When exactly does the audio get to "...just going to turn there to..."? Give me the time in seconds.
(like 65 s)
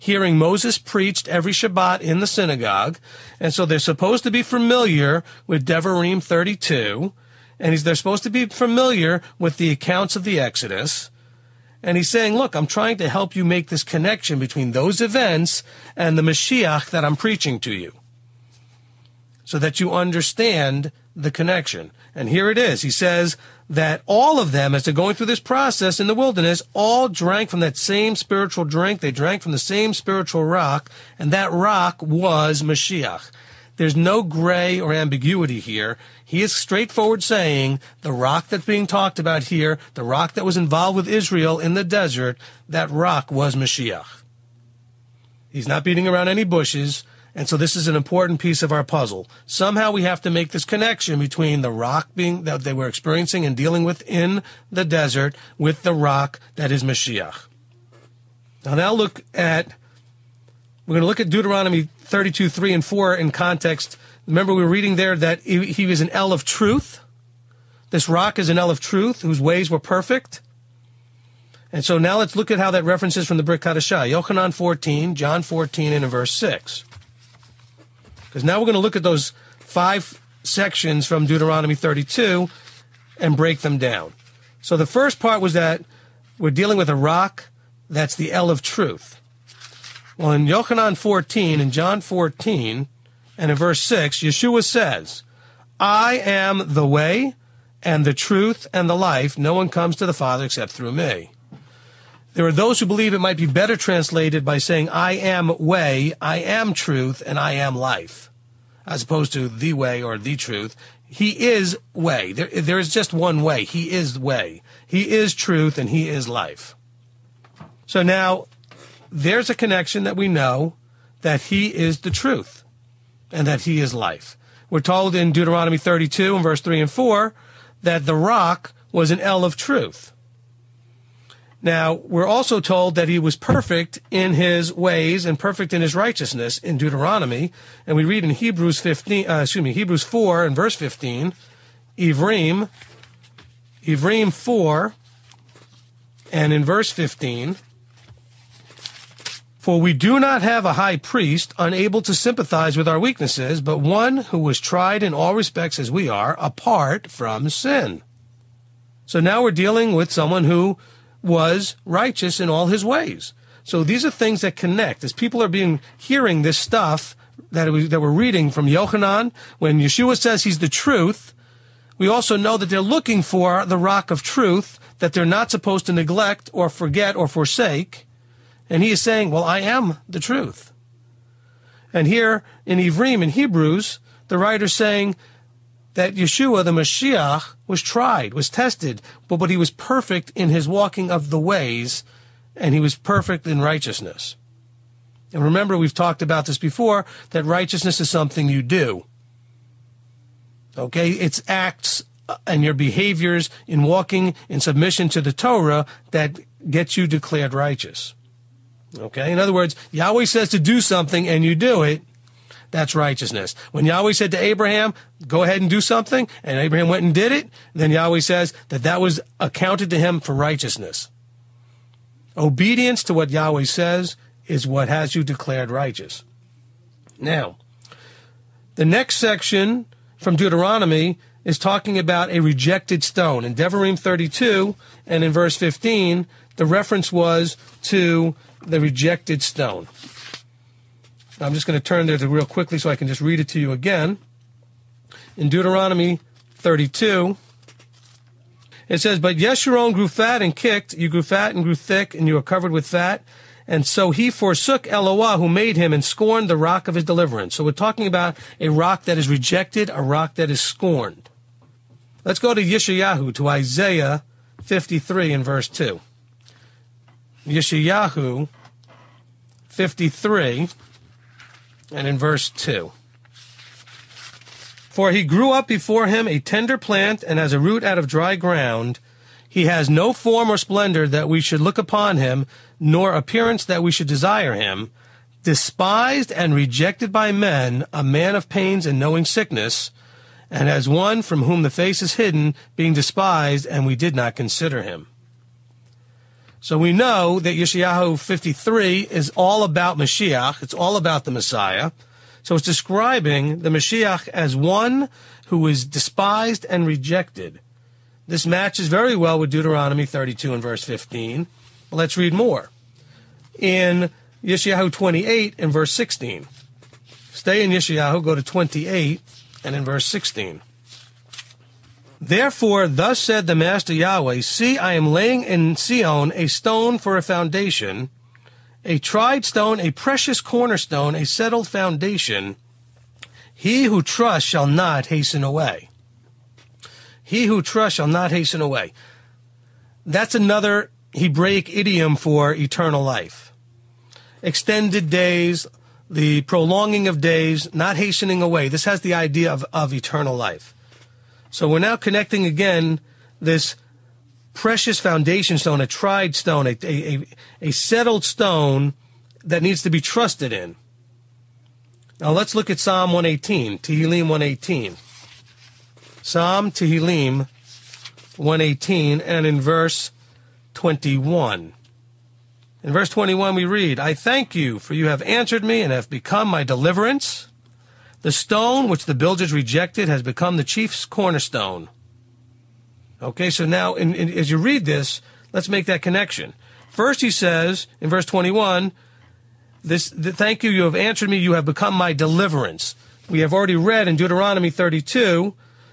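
241 s.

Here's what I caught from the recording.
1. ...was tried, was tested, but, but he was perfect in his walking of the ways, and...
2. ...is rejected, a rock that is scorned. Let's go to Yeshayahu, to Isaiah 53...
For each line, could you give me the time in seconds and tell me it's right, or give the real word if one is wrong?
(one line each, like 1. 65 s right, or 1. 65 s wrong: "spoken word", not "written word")
1. 187 s right
2. 259 s right.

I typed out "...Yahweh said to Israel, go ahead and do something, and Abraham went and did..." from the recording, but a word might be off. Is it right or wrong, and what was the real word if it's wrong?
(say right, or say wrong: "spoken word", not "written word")
wrong: "Abraham", not "Israel".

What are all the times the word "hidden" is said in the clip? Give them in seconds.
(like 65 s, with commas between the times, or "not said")
292 s.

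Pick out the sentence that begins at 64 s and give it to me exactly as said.
Remember we were reading there that he, was an El of truth.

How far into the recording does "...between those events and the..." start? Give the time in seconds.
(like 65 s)
14 s.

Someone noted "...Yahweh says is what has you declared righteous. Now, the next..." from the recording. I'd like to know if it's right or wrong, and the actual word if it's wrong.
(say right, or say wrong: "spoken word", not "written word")
right.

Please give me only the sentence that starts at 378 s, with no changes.
The stone which the builders rejected has become the chief's cornerstone.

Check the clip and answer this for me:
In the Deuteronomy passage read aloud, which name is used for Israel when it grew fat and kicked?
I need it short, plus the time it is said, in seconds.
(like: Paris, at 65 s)
Yeshurun, at 249 s.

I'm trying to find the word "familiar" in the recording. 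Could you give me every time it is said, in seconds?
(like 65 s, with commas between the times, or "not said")
4 s, 8 s.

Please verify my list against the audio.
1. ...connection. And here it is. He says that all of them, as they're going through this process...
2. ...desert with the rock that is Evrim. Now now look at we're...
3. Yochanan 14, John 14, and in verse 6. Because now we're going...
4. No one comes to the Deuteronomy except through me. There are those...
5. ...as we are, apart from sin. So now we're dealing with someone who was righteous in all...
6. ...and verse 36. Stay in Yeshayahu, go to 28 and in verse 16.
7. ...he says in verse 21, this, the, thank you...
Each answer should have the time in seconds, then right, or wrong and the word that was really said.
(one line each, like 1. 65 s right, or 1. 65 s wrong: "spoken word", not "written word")
1. 21 s right
2. 54 s wrong: "Mashiach", not "Evrim"
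3. 74 s right
4. 99 s wrong: "Father", not "Deuteronomy"
5. 155 s right
6. 315 s wrong: "16", not "36"
7. 387 s right.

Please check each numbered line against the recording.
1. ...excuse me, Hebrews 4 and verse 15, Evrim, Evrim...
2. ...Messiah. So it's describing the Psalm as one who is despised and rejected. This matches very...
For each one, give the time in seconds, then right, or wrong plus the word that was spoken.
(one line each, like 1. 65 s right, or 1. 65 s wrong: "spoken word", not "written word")
1. 139 s right
2. 301 s wrong: "Mashiach", not "Psalm".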